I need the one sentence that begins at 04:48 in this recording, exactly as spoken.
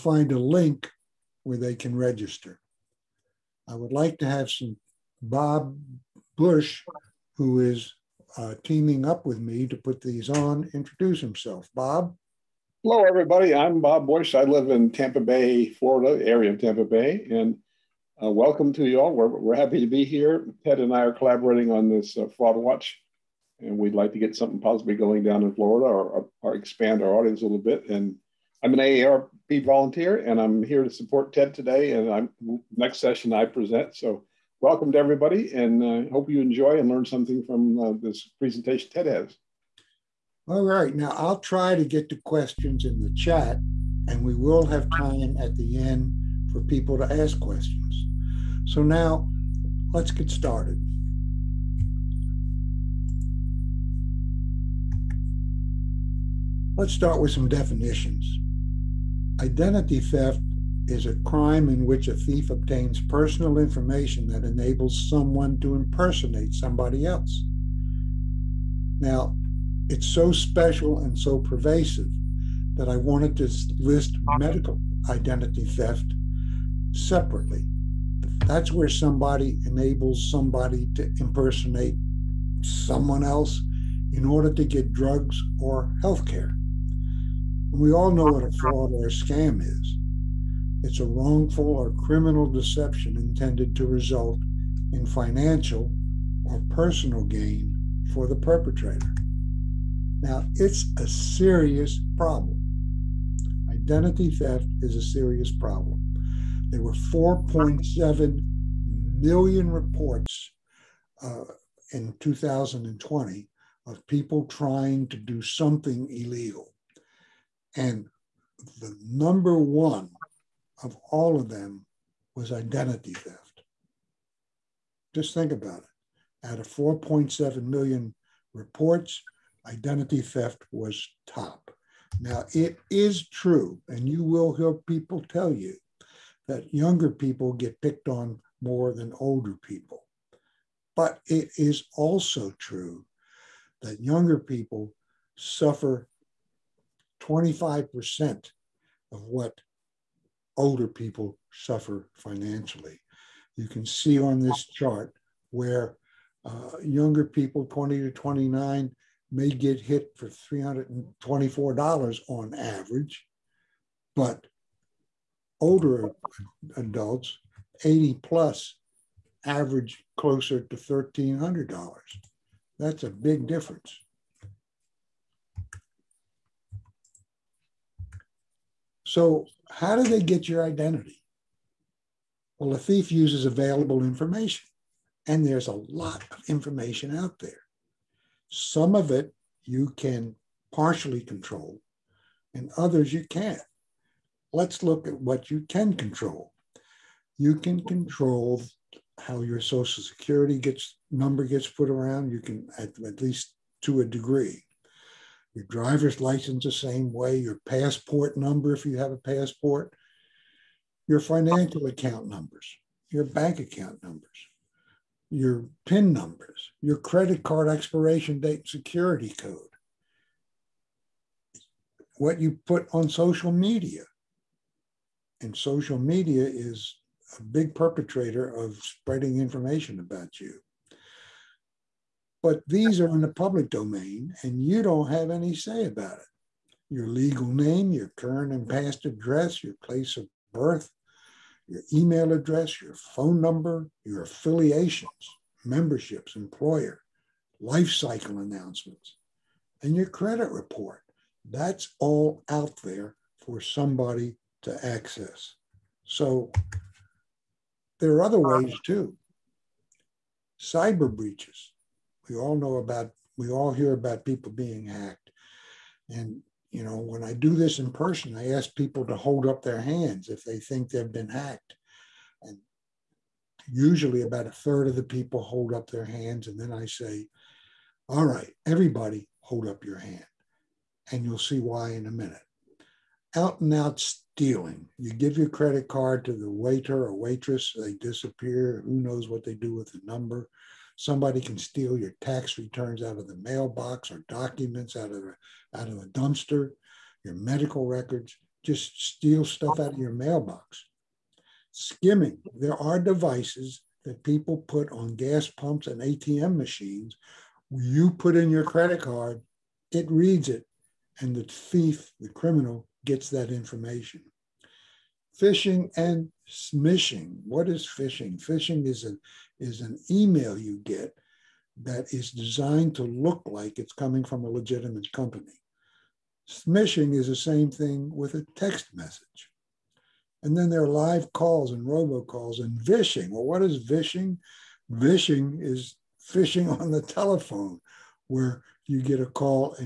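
Who knows what they do with the number?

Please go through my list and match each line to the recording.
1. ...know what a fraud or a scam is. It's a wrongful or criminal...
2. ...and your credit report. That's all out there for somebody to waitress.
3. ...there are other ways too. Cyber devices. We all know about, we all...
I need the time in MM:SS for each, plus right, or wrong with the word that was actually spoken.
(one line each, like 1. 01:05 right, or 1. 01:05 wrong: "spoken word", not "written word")
1. 01:28 right
2. 04:09 wrong: "access", not "waitress"
3. 04:17 wrong: "breaches", not "devices".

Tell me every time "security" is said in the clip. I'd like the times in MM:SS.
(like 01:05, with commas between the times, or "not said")
03:20, 03:38.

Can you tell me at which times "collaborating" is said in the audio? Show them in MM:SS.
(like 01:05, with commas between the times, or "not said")
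00:21.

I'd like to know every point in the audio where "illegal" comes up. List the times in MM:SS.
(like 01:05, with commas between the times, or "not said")
01:56.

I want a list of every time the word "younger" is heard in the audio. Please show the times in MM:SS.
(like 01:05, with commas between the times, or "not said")
02:16, 02:24, 02:36.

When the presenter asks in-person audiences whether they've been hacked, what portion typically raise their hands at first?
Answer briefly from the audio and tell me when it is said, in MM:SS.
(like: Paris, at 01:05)
about a third, at 04:34.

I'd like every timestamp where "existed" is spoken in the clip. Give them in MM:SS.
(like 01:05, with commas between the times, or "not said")
not said.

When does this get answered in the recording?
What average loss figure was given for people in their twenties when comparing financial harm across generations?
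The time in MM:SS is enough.
02:40.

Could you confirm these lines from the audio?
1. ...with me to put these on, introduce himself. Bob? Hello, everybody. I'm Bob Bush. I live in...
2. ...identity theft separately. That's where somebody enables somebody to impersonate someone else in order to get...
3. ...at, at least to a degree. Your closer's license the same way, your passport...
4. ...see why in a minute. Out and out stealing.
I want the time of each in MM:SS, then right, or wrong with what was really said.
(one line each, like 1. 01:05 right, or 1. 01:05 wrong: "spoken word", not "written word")
1. 00:09 right
2. 01:15 right
3. 03:22 wrong: "driver", not "closer"
4. 04:41 right.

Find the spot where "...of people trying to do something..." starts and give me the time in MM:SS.
01:53.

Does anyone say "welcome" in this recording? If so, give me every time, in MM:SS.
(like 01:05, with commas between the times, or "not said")
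00:18, 00:34.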